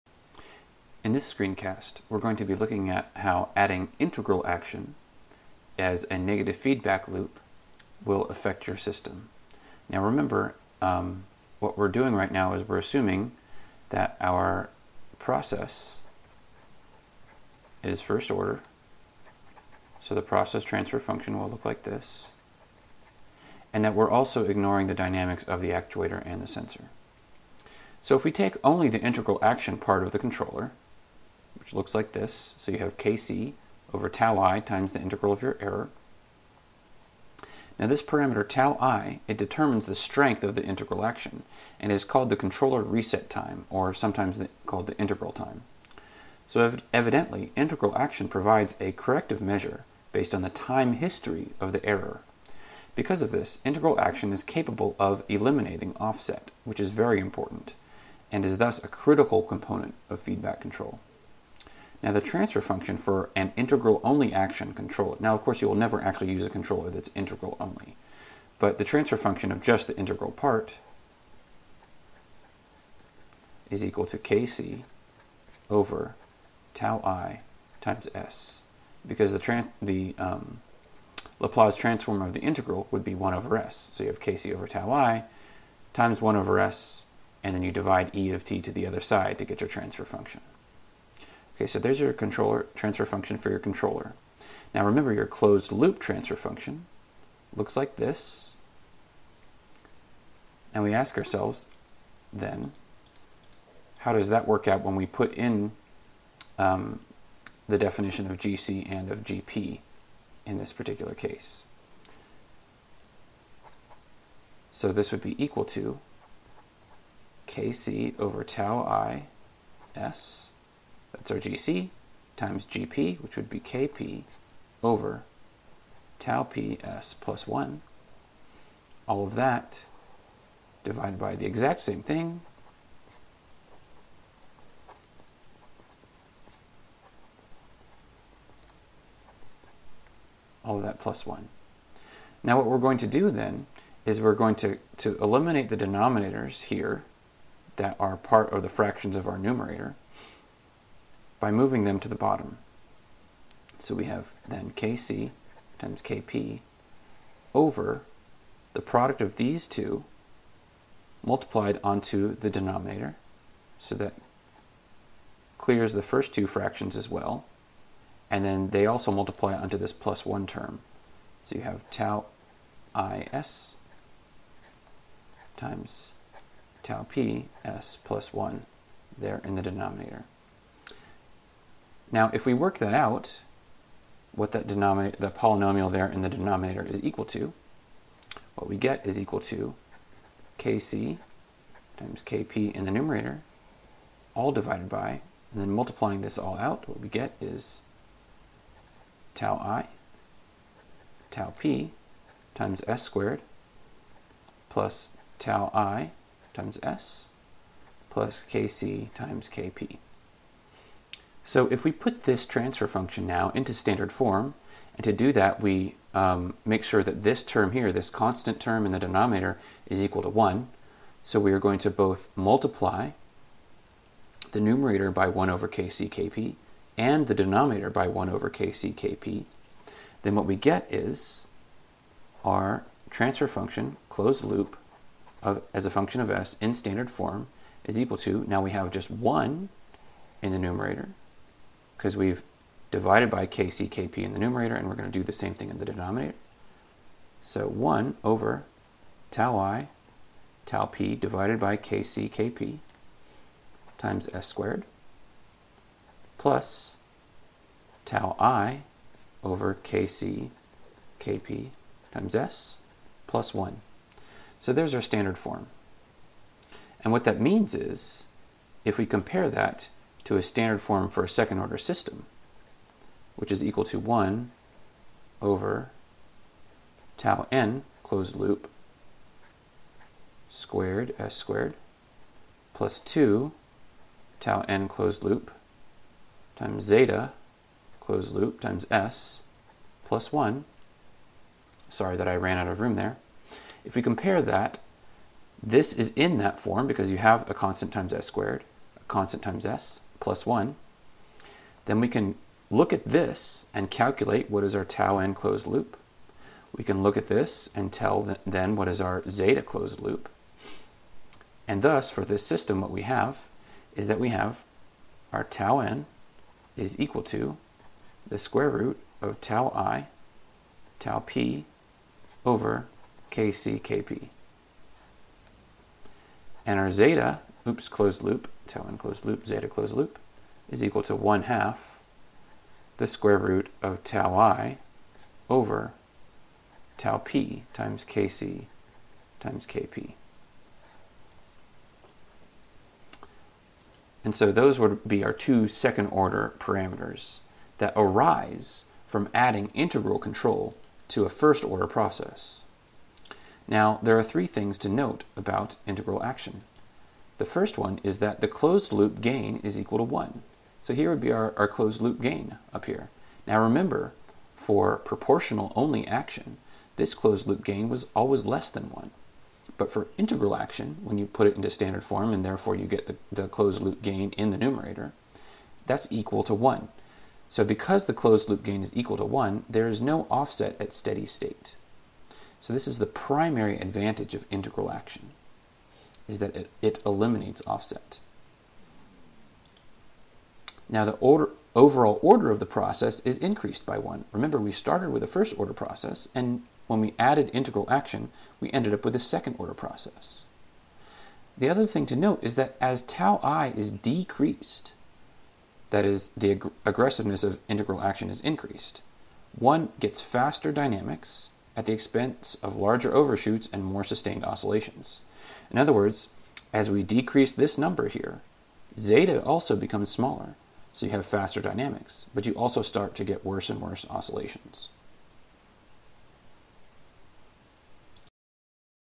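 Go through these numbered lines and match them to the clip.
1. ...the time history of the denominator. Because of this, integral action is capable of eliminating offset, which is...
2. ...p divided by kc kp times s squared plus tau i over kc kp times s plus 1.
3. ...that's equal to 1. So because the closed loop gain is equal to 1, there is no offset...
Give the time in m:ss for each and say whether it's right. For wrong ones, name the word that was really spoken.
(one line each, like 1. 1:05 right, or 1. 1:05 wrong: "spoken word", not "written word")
1. 0:50 wrong: "error", not "denominator"
2. 4:10 right
3. 6:15 right.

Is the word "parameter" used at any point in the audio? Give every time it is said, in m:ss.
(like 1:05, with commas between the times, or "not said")
0:38, 5:46.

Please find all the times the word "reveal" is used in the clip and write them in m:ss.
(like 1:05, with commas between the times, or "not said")
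not said.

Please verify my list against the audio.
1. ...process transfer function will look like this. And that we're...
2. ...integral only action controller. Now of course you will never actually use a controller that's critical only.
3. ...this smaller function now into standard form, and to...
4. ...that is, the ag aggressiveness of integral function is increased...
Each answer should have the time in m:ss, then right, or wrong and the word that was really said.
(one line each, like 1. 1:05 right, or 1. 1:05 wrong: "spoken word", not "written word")
1. 0:20 right
2. 1:03 wrong: "integral", not "critical"
3. 3:32 wrong: "transfer", not "smaller"
4. 6:45 wrong: "action", not "function".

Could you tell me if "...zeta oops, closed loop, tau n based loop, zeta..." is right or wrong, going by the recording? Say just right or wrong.
wrong.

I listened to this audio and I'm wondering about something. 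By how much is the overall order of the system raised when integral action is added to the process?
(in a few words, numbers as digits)
1.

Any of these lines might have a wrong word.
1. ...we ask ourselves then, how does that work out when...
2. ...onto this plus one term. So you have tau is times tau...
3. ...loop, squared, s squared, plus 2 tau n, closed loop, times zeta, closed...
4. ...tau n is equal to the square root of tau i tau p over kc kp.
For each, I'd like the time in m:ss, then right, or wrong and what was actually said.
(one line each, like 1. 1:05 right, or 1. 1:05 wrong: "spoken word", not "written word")
1. 1:40 right
2. 2:49 right
3. 4:38 right
4. 5:15 right.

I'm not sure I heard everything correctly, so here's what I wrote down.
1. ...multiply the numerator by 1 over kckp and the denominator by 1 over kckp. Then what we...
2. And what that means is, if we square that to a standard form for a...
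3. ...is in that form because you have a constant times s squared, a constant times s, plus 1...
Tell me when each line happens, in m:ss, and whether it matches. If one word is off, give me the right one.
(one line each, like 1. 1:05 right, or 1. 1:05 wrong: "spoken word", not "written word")
1. 3:42 right
2. 4:27 wrong: "compare", not "square"
3. 4:55 right.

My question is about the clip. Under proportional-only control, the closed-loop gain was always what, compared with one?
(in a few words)
less than 1.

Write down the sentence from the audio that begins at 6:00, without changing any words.
So here would be our, our closed loop gain up here.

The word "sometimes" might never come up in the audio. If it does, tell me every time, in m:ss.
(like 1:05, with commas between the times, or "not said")
0:43.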